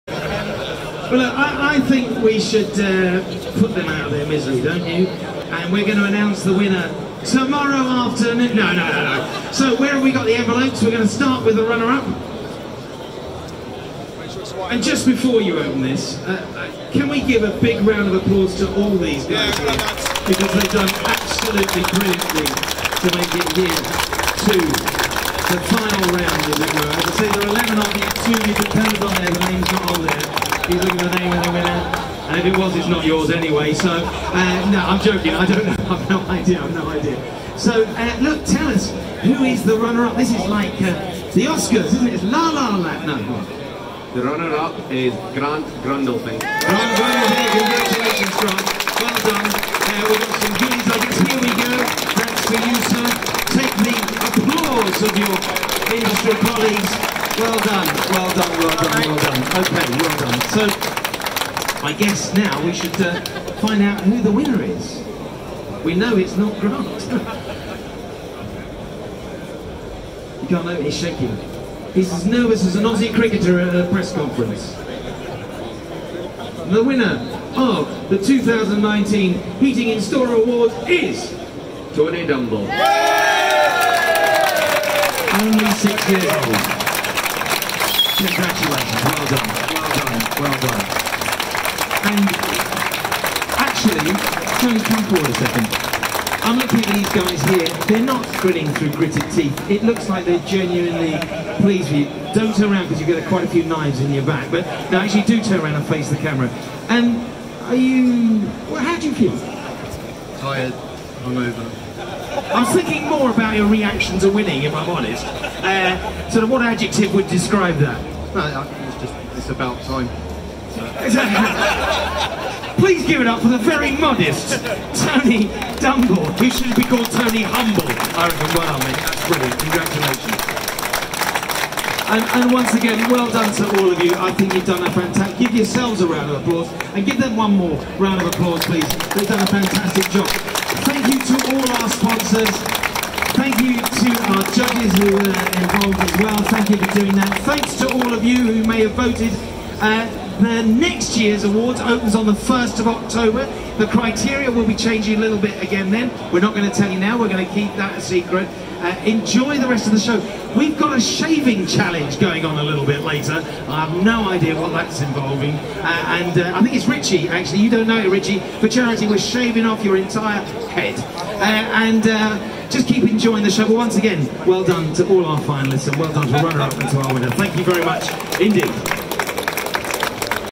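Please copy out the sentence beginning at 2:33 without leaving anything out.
The criteria will be changing a little bit again then.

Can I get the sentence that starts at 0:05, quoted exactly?
And we're going to announce the winner tomorrow afternoon.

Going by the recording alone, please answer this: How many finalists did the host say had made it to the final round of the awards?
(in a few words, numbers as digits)
11.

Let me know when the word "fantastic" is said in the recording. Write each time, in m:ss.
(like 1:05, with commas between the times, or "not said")
2:14, 2:19.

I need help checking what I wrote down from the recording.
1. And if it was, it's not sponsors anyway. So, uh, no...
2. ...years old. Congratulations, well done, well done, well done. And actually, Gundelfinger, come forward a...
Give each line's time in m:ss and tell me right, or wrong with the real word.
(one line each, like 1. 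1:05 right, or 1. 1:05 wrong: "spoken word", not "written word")
1. 0:32 wrong: "yours", not "sponsors"
2. 1:26 wrong: "Tony", not "Gundelfinger".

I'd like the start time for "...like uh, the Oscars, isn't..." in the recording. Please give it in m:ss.
0:40.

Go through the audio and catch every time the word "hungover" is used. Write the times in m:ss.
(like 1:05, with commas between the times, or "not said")
1:51.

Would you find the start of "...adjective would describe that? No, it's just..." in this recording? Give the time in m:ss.
1:56.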